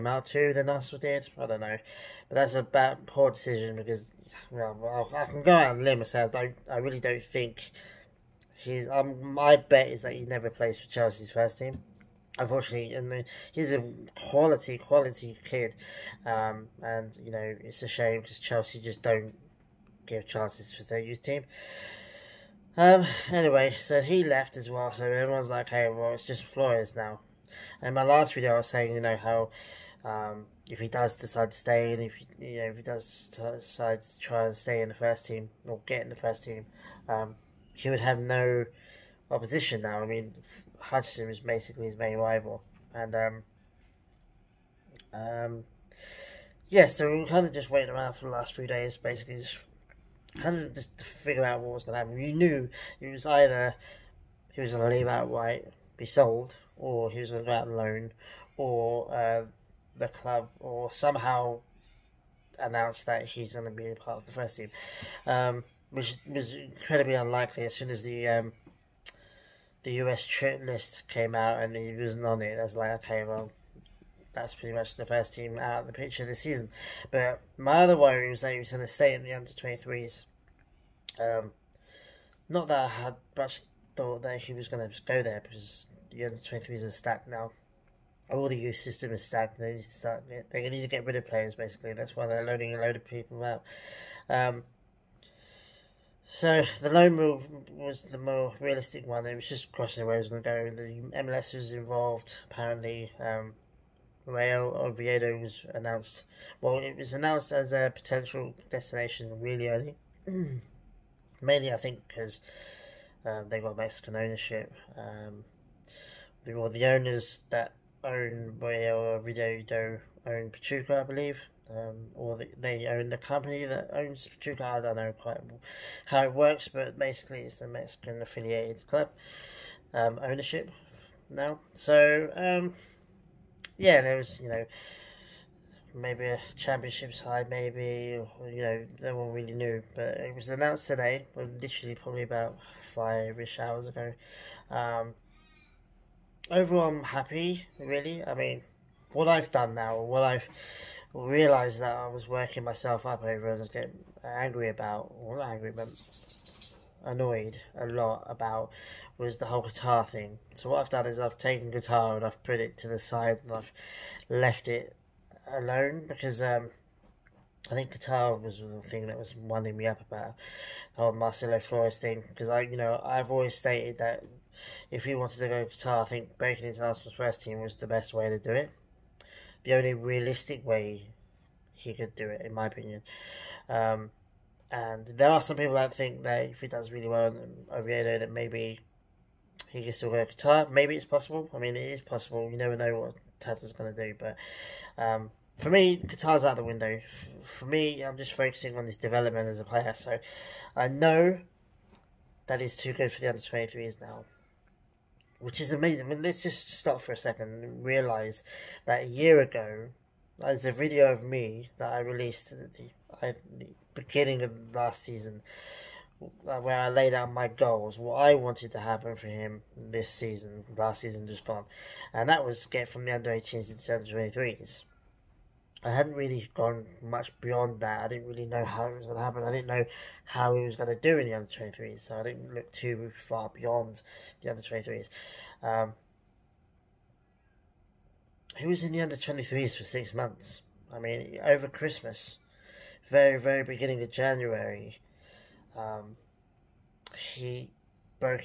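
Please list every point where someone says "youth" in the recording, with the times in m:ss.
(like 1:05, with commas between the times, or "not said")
0:20, 1:28.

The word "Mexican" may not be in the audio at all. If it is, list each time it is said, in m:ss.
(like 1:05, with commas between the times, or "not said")
1:53, 2:07.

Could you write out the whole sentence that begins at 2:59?
The only realistic way he could do it, in my opinion.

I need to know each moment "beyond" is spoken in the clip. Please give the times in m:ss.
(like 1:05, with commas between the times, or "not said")
3:47, 3:53.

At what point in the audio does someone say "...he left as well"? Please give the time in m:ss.
0:24.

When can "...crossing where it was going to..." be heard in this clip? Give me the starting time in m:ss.
1:39.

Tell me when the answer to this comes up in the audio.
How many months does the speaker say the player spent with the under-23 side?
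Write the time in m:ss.
3:59.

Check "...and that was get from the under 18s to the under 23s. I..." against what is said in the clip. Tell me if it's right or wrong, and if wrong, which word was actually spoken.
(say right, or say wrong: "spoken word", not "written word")
right.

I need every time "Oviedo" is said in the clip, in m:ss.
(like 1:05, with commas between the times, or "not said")
1:44, 1:58, 3:07.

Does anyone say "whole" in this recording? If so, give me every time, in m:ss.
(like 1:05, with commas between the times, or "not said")
2:39, 2:51.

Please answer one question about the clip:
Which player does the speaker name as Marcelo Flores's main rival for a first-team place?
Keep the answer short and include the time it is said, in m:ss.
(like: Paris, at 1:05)
Hutchinson, at 0:40.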